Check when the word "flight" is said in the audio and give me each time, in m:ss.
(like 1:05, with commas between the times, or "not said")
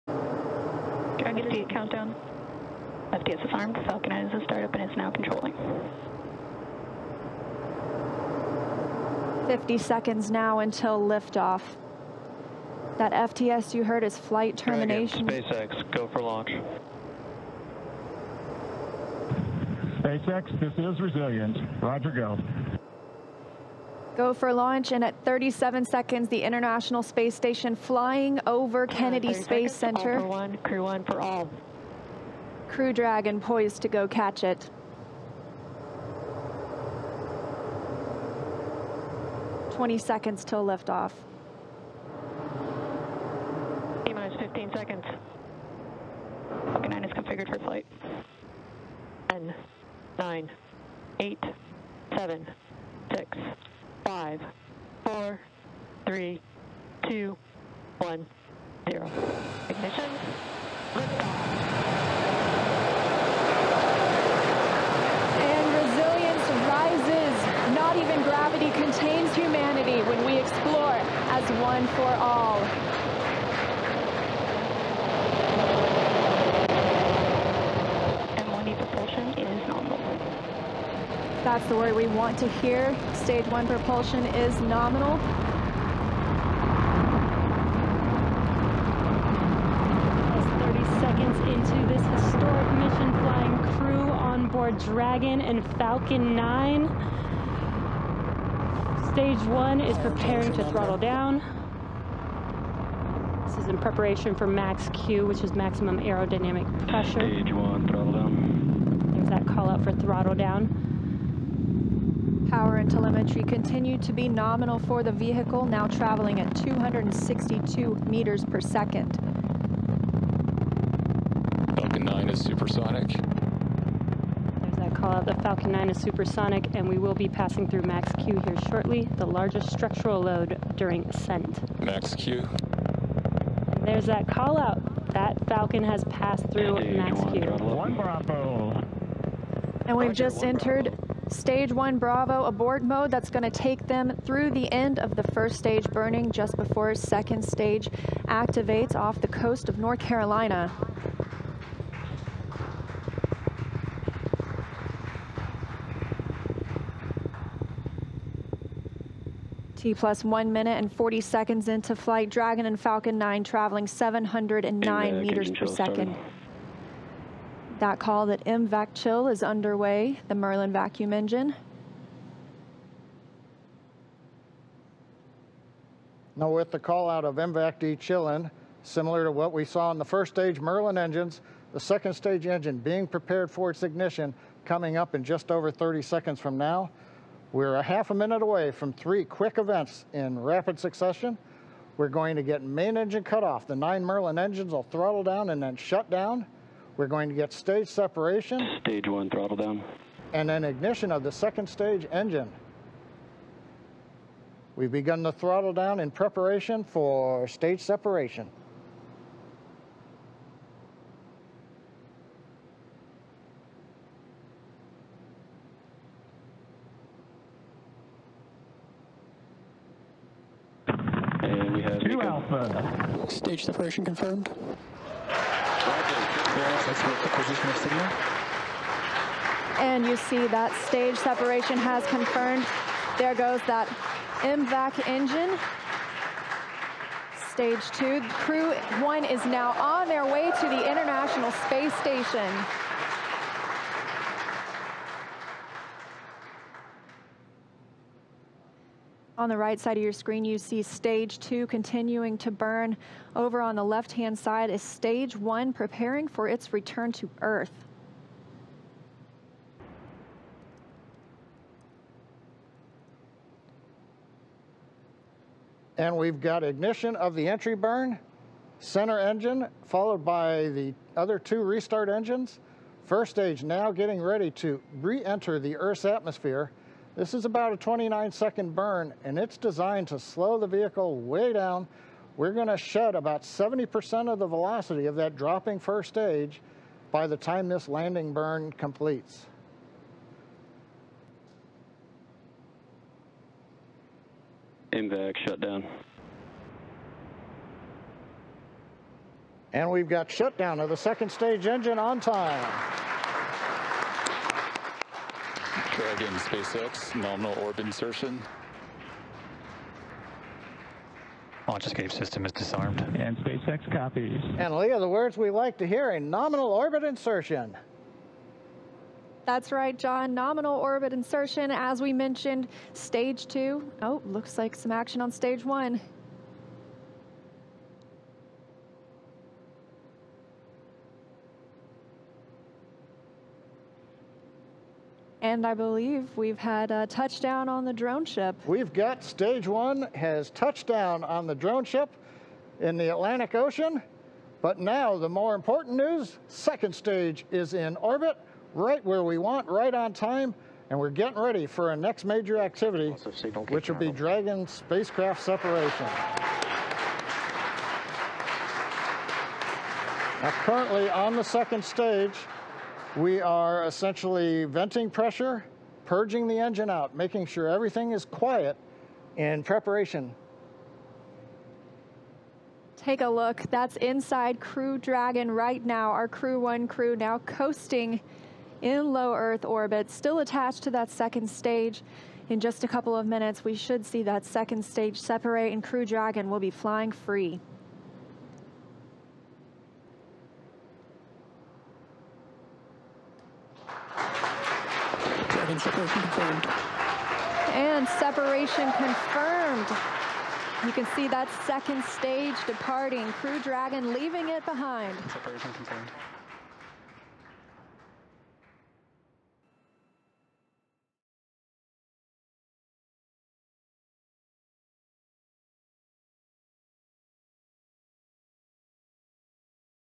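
0:14, 0:47, 2:41.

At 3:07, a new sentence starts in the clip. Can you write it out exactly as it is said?
We're a half a minute away from three quick events in rapid succession.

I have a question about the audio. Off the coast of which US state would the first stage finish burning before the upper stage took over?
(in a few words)
North Carolina.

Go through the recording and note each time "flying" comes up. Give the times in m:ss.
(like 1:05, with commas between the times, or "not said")
0:27, 1:33, 6:26.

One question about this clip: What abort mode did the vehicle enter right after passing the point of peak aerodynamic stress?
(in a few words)
Stage 1 Bravo.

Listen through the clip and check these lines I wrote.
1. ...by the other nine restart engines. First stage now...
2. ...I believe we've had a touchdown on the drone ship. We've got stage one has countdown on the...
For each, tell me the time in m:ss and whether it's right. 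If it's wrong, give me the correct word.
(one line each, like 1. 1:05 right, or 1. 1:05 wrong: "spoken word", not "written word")
1. 4:30 wrong: "two", not "nine"
2. 5:35 wrong: "touchdown", not "countdown".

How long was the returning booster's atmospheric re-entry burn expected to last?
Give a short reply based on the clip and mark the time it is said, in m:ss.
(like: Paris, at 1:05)
29 seconds, at 4:37.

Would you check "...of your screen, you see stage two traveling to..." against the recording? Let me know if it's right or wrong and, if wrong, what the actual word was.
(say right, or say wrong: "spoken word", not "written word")
wrong: "continuing", not "traveling".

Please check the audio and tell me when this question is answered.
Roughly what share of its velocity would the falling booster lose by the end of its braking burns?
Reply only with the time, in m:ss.
4:43.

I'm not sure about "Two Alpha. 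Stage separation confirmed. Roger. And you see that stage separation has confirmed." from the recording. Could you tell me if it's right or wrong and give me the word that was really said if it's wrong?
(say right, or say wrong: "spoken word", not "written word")
right.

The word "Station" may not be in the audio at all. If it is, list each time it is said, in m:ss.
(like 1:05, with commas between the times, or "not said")
0:27, 4:01.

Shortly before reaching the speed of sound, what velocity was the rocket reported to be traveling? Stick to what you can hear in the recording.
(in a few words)
262 meters per second.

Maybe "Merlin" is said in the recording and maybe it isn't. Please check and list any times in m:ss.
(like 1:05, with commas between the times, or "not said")
2:50, 3:00, 3:14.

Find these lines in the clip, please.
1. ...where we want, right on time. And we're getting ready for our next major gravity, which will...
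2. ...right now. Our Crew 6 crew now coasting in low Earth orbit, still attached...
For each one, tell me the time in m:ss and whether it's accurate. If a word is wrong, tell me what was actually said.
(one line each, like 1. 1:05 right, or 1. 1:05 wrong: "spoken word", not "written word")
1. 5:49 wrong: "activity", not "gravity"
2. 6:15 wrong: "1", not "6".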